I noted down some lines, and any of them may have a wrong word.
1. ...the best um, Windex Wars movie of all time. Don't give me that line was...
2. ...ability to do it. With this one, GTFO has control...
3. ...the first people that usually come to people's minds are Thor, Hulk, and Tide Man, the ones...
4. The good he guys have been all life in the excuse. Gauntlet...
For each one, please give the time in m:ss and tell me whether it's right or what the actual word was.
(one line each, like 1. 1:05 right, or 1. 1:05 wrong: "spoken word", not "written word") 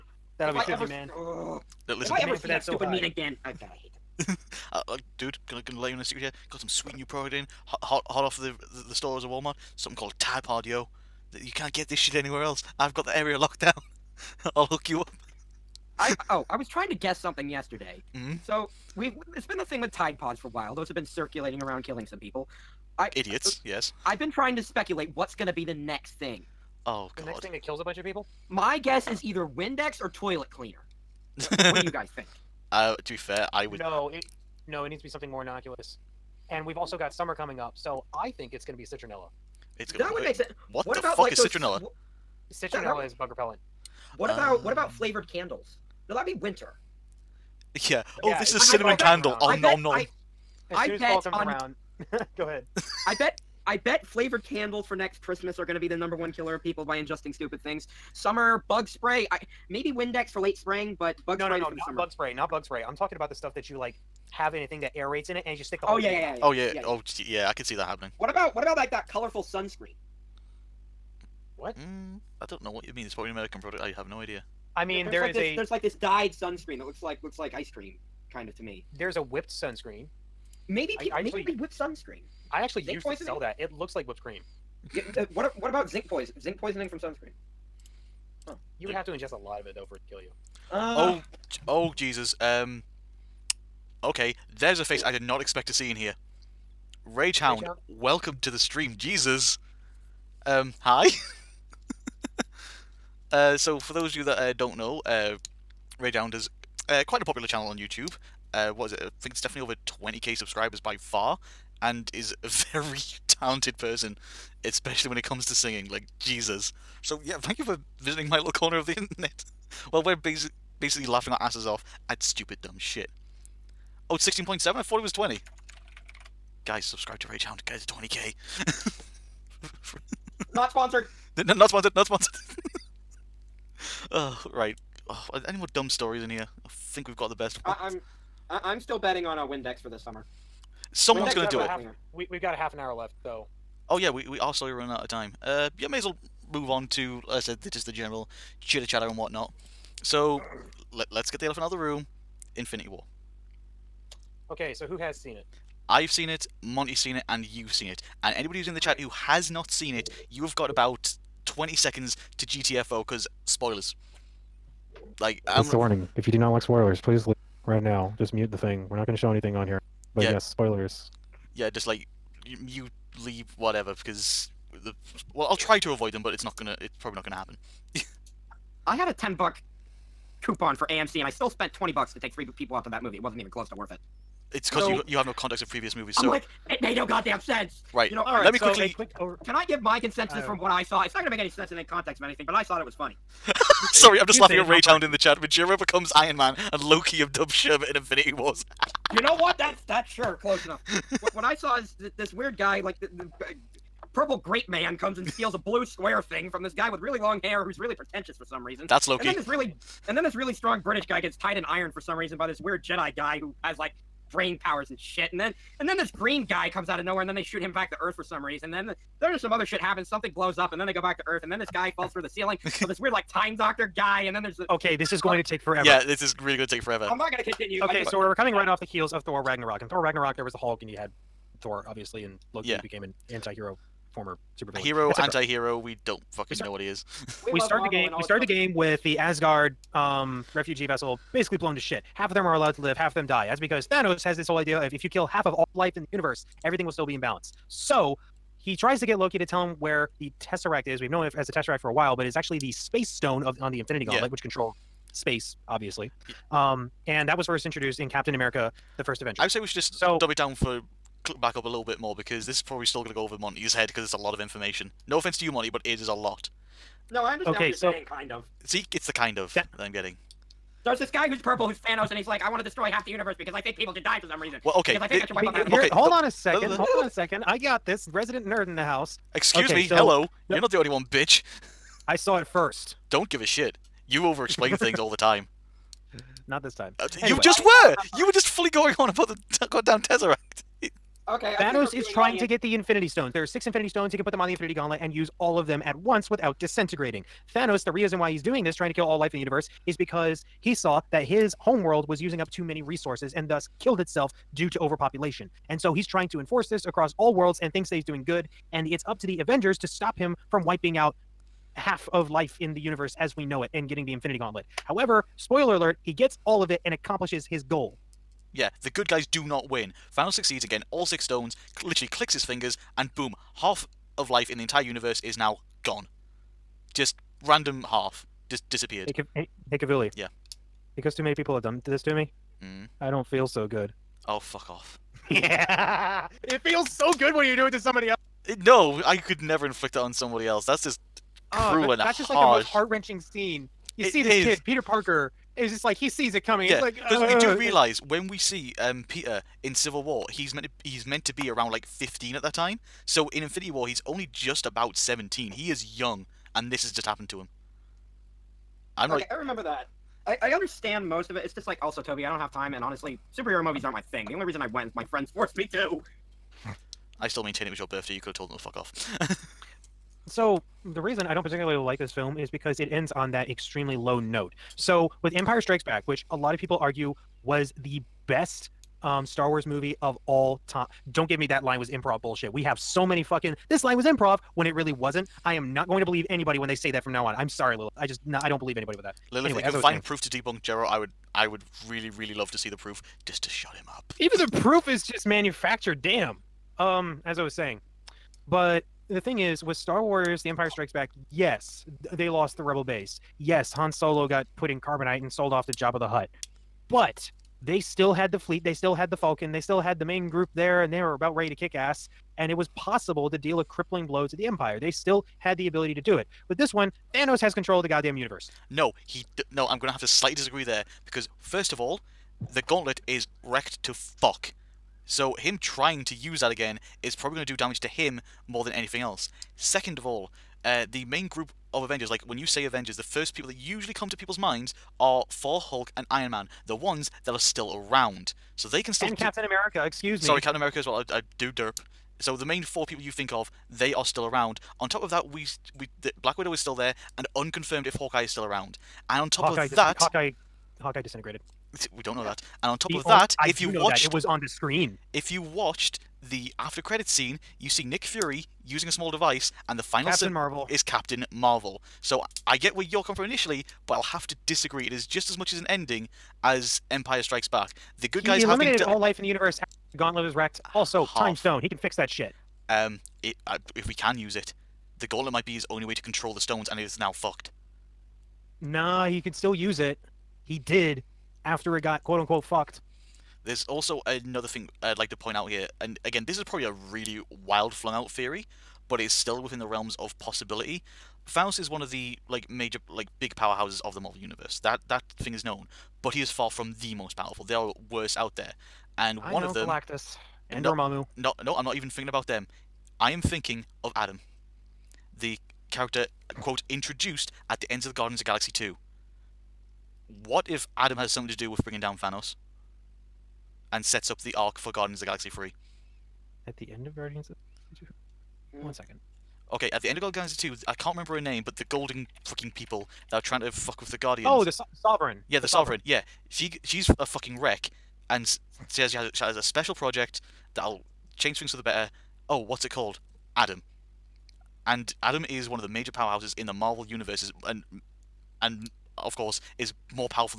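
1. 6:17 wrong: "Star", not "Windex"
2. 6:55 wrong: "Thanos", not "GTFO"
3. 7:12 wrong: "Iron", not "Tide"
4. 7:47 wrong: "universe", not "excuse".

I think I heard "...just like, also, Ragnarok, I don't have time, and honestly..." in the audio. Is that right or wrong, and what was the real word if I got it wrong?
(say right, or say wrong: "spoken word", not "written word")
wrong: "Toby", not "Ragnarok".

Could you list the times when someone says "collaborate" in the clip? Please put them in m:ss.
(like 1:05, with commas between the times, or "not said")
not said.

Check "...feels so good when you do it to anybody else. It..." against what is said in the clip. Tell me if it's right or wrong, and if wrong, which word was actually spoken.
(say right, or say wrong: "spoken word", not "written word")
wrong: "somebody", not "anybody".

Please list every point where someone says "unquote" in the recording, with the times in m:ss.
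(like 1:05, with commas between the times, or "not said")
8:02.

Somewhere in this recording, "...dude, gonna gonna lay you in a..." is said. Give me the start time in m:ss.
0:05.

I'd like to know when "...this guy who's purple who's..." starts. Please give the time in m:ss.
4:30.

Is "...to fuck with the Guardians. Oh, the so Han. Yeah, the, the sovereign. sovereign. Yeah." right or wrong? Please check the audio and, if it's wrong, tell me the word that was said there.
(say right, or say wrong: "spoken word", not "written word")
wrong: "Sovereign", not "Han".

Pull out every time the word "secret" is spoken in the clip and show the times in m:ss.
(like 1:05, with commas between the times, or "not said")
0:06.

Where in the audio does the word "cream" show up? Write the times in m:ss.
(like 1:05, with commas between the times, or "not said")
1:17, 1:24.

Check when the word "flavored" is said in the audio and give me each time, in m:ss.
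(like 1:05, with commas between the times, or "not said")
0:44, 0:54.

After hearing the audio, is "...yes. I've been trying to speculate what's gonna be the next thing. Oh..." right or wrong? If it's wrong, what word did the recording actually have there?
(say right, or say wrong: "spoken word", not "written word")
right.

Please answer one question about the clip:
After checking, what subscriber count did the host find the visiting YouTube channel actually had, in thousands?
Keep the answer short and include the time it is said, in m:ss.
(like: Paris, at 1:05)
16.7, at 2:04.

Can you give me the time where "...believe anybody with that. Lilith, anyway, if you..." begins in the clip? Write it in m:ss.
6:28.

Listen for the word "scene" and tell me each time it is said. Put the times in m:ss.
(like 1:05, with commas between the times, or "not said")
5:43, 7:37.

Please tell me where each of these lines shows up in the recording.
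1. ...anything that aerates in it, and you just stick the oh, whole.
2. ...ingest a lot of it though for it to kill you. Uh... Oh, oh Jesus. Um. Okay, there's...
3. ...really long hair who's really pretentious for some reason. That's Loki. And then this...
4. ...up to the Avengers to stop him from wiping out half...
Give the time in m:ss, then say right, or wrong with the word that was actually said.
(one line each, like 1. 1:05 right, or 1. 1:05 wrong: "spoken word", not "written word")
1. 1:04 right
2. 1:29 right
3. 3:26 right
4. 5:09 right.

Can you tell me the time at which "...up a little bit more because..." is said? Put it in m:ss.
4:21.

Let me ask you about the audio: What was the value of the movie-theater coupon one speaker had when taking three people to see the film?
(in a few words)
10 dollars.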